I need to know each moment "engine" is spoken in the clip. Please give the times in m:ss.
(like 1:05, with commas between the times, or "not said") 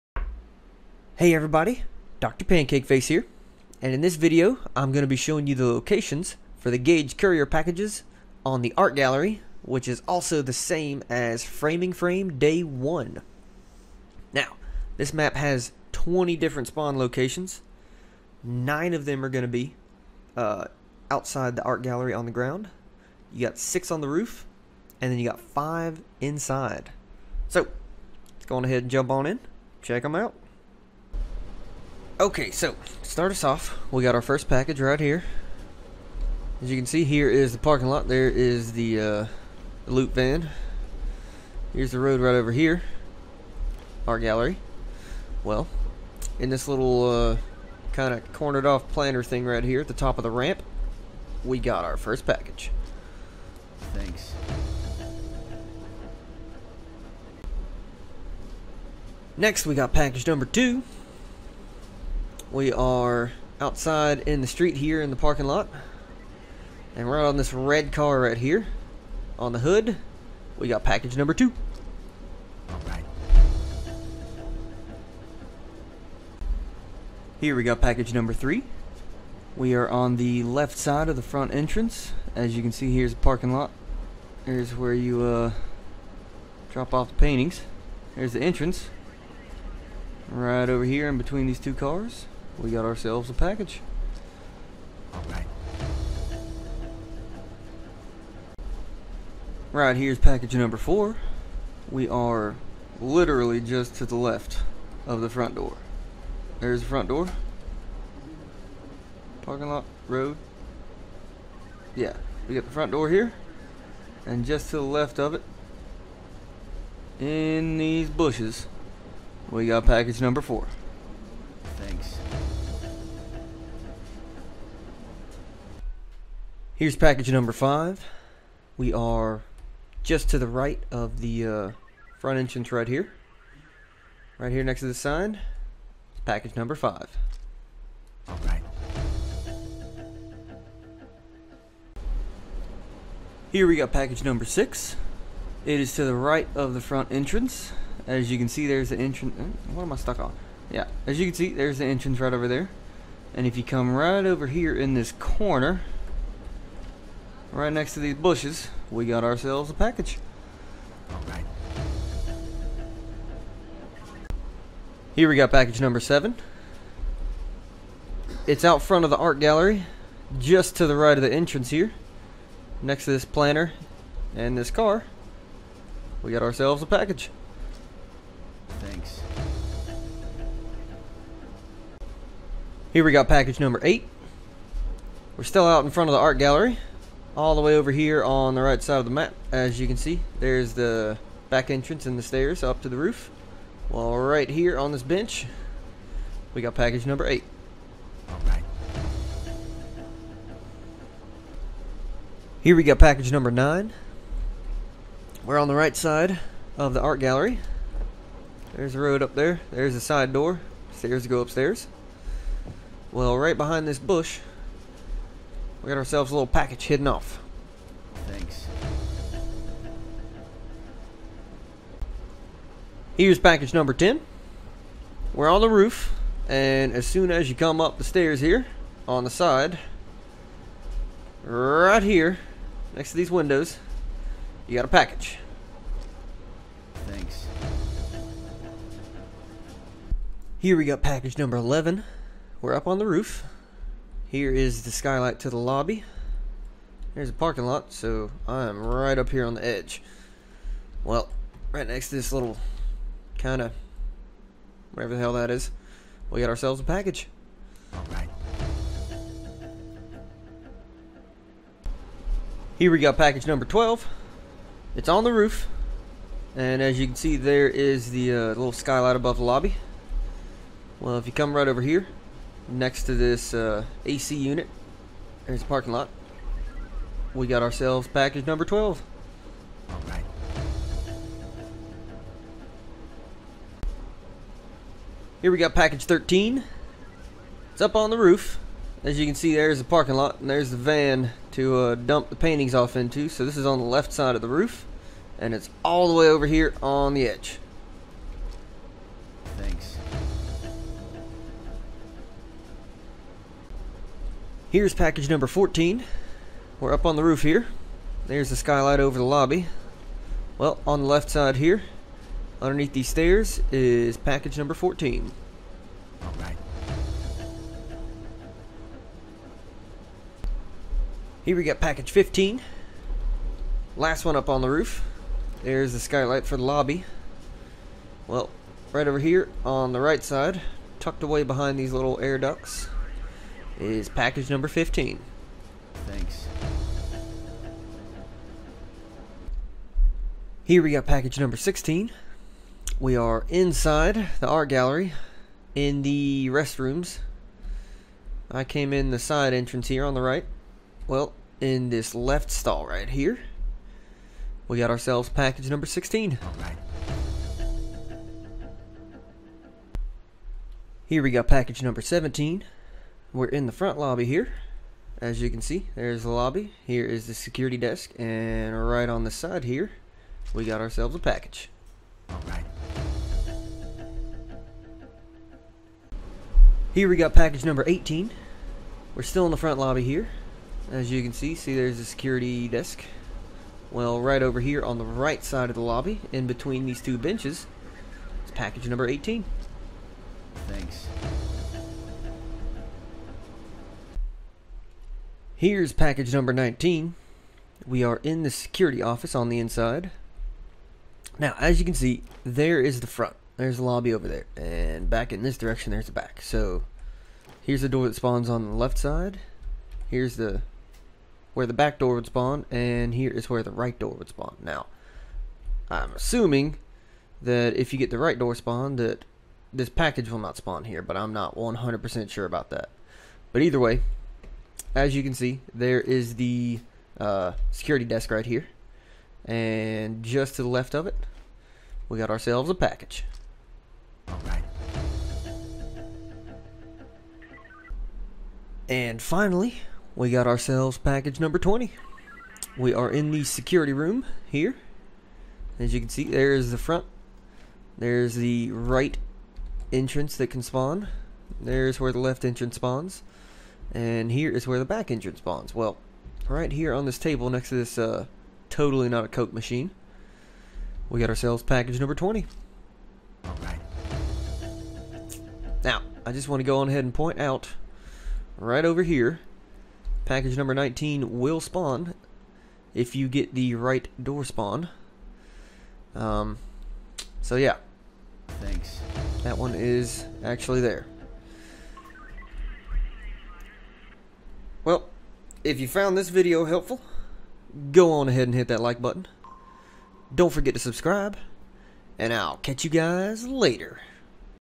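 7:35.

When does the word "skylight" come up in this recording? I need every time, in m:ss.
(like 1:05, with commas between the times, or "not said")
4:04, 4:28, 5:08, 5:25.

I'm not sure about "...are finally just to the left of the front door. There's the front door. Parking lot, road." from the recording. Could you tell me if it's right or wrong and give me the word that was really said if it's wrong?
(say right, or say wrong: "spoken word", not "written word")
wrong: "literally", not "finally".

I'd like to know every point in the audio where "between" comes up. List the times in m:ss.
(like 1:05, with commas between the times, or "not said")
1:31, 6:26.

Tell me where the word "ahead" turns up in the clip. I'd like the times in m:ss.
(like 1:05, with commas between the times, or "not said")
0:28, 7:46, 8:08.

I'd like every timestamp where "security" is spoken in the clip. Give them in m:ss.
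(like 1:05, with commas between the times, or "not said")
6:07, 6:22, 6:38, 7:07, 7:23.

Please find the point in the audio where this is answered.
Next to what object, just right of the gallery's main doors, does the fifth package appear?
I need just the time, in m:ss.
2:14.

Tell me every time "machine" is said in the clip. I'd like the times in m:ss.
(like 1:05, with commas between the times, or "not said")
7:39.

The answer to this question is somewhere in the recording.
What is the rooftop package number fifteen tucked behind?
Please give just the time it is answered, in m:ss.
5:32.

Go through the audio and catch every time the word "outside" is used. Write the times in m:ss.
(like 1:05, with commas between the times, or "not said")
0:21, 1:03.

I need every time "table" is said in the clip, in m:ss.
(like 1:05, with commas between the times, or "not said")
7:37.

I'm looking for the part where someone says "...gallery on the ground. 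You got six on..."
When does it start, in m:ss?
0:21.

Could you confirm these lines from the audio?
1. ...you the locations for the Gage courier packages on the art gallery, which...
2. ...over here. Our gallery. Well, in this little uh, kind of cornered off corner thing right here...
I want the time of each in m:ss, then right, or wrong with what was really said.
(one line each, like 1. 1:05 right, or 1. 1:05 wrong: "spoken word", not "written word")
1. 0:05 right
2. 0:42 wrong: "planter", not "corner".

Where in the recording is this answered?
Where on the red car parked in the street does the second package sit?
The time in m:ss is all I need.
1:09.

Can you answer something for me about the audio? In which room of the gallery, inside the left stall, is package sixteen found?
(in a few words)
the restrooms.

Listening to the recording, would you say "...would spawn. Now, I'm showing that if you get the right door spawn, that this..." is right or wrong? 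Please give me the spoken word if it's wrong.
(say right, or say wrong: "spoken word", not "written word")
wrong: "assuming", not "showing".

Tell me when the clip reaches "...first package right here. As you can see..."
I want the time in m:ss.
0:34.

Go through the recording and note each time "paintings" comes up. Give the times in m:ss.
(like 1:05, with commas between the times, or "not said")
1:27, 4:52.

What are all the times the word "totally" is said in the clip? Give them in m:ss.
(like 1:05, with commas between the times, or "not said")
7:38.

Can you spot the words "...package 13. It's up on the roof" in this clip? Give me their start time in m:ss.
4:45.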